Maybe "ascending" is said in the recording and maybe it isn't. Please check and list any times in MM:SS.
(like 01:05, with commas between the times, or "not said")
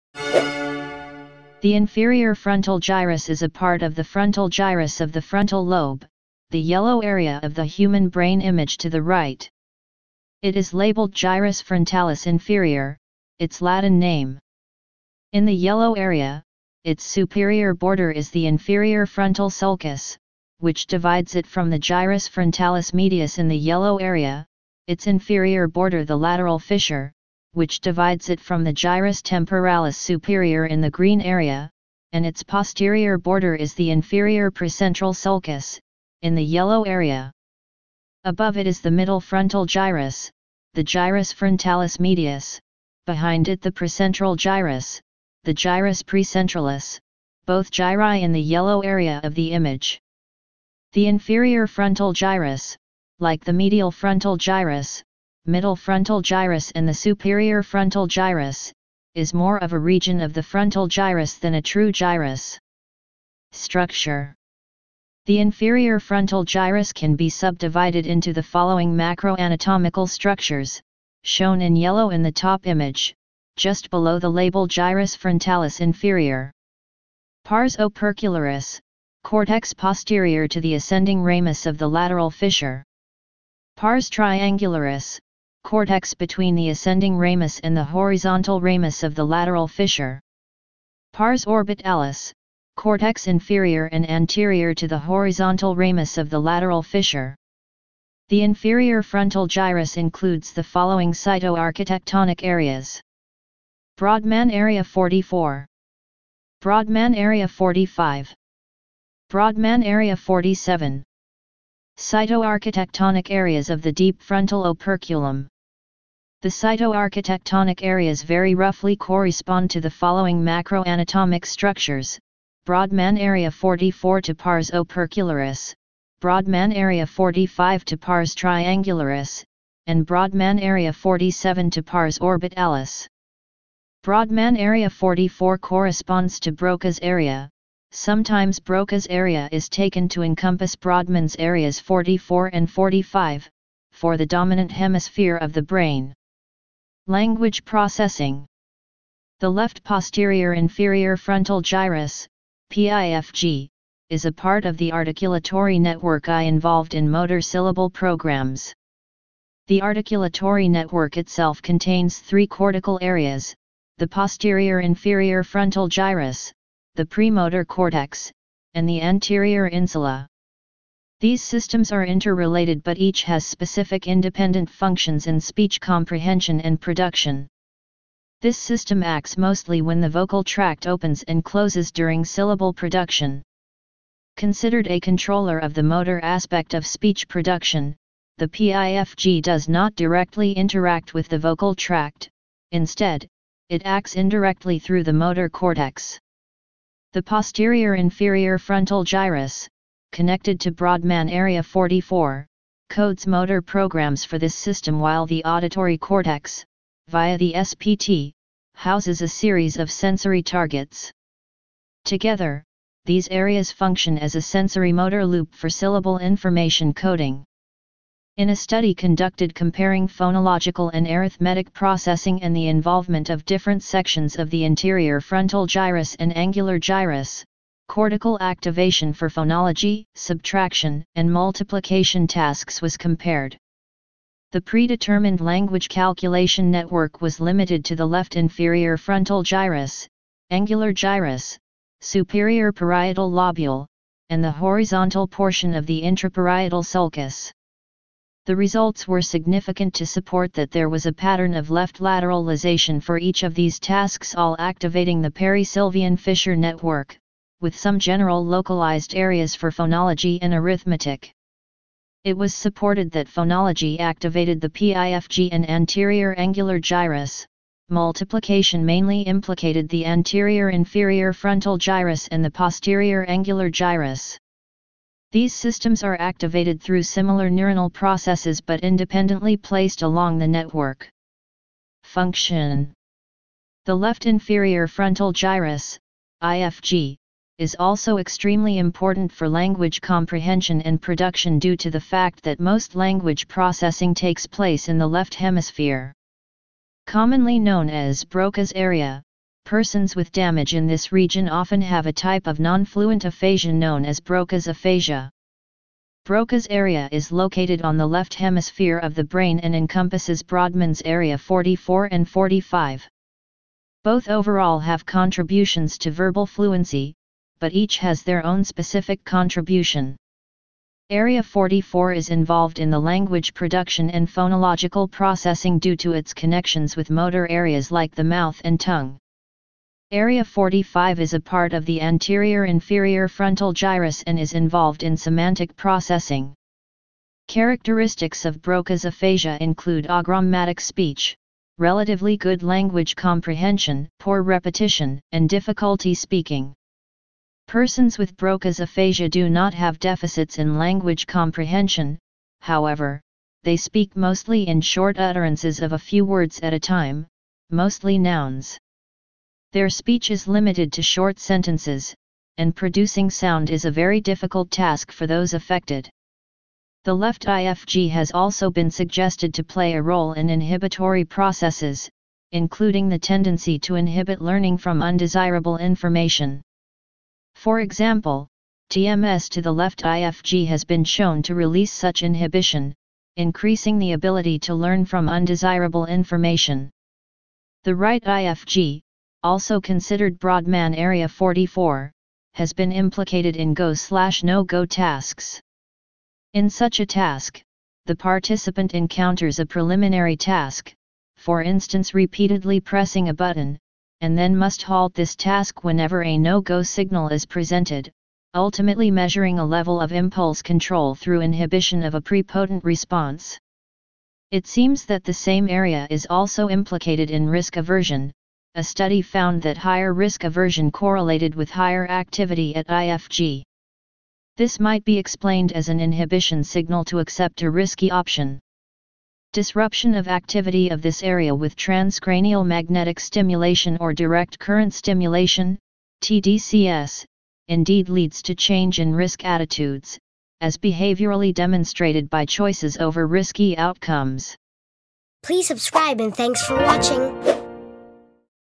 01:20, 01:26.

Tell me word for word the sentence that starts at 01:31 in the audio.
Pars orbitalis cortex inferior and anterior to the horizontal ramus of the lateral fissure.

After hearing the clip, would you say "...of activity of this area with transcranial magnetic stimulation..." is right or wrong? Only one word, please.
right.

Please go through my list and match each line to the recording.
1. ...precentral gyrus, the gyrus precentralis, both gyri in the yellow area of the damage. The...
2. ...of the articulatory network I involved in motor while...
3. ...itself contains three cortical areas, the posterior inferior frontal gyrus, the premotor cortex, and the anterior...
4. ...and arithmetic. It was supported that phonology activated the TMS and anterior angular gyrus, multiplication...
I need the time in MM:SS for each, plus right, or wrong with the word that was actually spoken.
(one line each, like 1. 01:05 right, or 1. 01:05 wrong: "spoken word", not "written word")
1. 00:43 wrong: "image", not "damage"
2. 02:34 wrong: "syllable", not "while"
3. 02:41 right
4. 04:20 wrong: "PIFG", not "TMS".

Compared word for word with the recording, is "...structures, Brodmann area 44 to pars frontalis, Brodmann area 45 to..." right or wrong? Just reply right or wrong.
wrong.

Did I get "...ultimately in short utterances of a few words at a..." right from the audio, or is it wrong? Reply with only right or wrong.
wrong.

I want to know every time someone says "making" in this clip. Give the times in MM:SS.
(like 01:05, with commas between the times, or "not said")
not said.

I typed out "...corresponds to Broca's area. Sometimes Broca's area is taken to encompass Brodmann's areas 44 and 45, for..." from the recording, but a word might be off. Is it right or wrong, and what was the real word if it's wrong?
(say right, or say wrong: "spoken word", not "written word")
right.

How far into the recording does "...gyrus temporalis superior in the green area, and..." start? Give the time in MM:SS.
00:28.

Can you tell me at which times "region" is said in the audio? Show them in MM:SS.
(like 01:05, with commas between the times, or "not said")
00:59, 05:01.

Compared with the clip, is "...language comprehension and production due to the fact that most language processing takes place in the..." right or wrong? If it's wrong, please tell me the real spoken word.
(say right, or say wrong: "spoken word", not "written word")
right.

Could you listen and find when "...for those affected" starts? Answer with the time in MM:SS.
06:05.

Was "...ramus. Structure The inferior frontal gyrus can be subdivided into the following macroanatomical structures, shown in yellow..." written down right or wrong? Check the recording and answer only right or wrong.
wrong.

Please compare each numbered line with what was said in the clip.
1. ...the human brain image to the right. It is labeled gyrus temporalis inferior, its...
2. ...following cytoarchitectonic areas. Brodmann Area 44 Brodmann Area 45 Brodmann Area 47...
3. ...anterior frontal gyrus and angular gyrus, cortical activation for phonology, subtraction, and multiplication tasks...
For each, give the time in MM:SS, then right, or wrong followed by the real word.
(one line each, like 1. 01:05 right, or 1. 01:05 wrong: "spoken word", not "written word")
1. 00:07 wrong: "frontalis", not "temporalis"
2. 01:40 right
3. 03:44 right.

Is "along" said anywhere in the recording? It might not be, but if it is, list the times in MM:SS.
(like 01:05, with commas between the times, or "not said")
04:40.